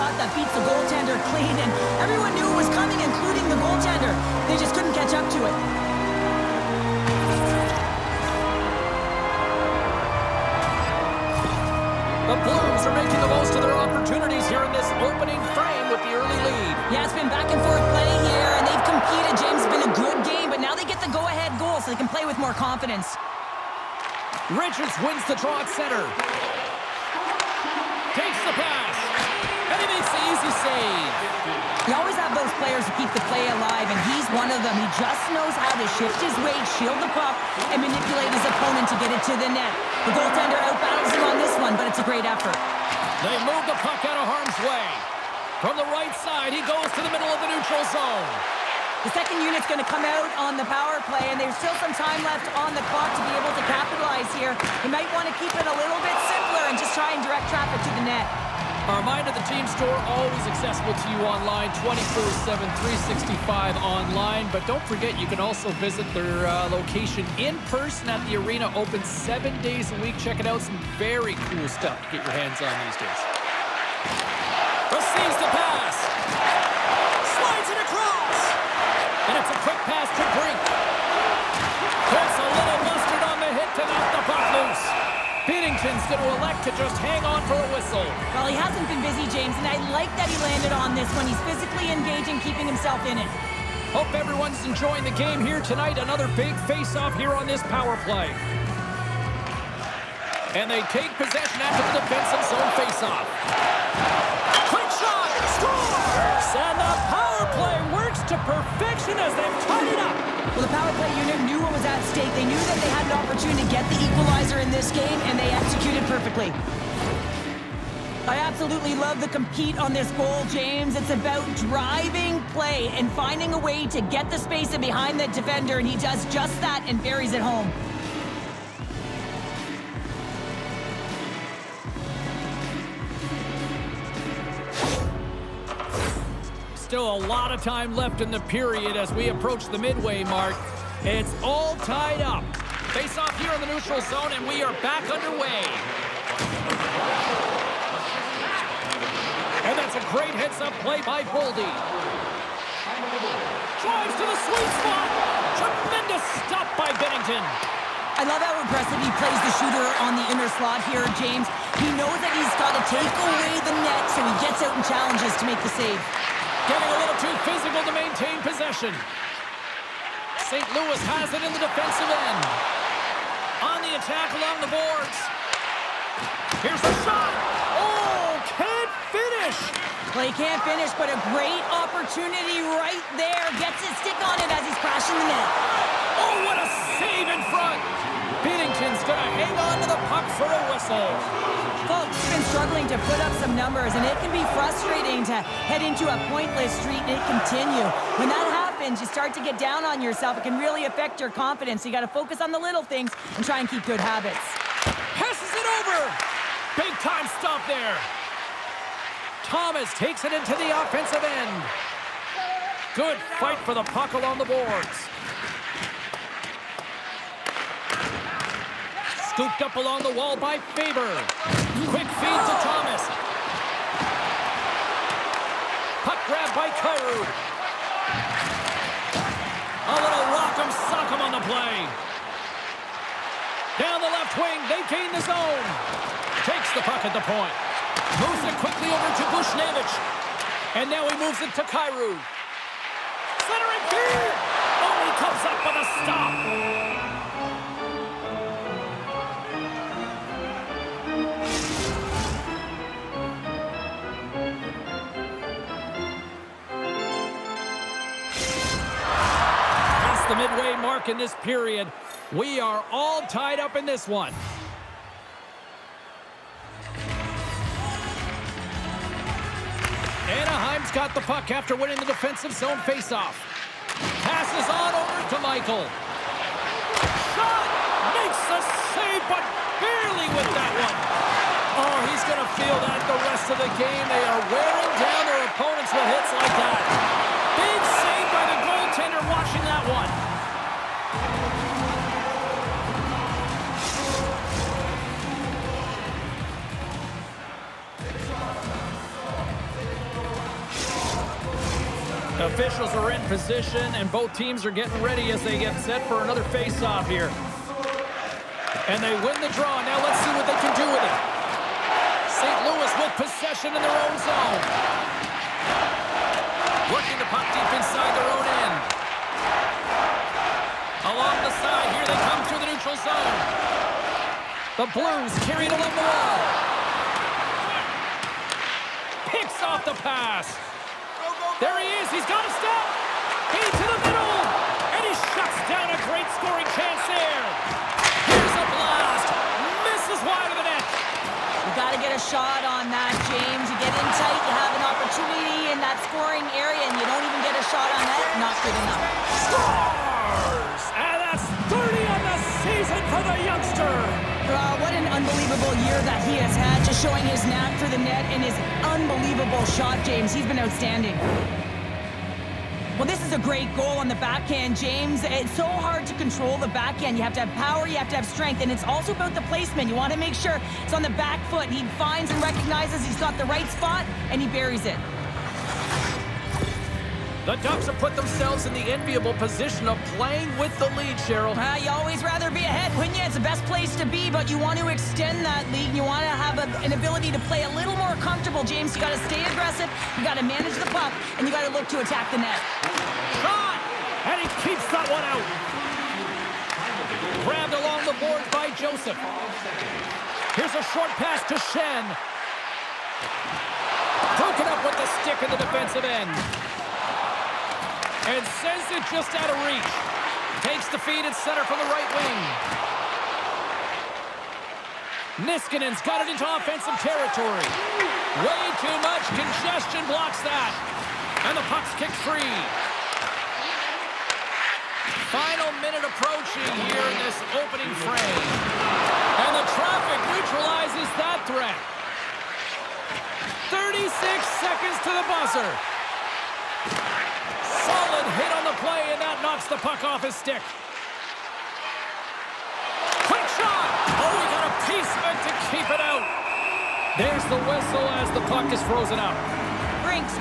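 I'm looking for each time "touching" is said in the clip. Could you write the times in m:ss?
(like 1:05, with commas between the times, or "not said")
not said.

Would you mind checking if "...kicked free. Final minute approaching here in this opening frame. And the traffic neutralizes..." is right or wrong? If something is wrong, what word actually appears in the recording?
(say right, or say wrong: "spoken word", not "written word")
right.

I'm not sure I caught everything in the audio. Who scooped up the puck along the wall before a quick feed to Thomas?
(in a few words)
Faber.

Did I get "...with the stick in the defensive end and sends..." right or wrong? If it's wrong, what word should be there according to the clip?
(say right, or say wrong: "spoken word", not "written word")
right.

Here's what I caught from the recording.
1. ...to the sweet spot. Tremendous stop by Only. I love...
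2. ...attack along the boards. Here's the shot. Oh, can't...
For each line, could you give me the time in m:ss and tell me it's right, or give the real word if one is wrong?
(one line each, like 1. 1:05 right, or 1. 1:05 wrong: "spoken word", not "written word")
1. 2:34 wrong: "Binnington", not "Only"
2. 2:54 right.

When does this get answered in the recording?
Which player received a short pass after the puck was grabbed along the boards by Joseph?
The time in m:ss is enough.
6:40.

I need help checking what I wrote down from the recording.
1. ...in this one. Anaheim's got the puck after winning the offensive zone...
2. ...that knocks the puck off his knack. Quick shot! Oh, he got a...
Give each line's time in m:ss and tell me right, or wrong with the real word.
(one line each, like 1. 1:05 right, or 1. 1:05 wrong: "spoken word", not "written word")
1. 4:23 wrong: "defensive", not "offensive"
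2. 7:19 wrong: "stick", not "knack".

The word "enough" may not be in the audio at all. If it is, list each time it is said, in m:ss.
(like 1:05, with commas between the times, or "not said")
5:48.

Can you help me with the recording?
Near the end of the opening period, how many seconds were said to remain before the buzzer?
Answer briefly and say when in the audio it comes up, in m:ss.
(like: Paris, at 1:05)
36, at 7:13.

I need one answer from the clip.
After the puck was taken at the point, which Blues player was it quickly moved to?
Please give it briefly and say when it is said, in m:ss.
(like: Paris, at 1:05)
Buchnevich, at 3:58.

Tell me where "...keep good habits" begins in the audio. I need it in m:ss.
3:23.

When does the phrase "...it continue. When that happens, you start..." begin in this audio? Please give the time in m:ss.
3:17.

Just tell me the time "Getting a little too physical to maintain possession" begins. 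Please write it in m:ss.
2:46.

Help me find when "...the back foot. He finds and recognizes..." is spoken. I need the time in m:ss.
6:11.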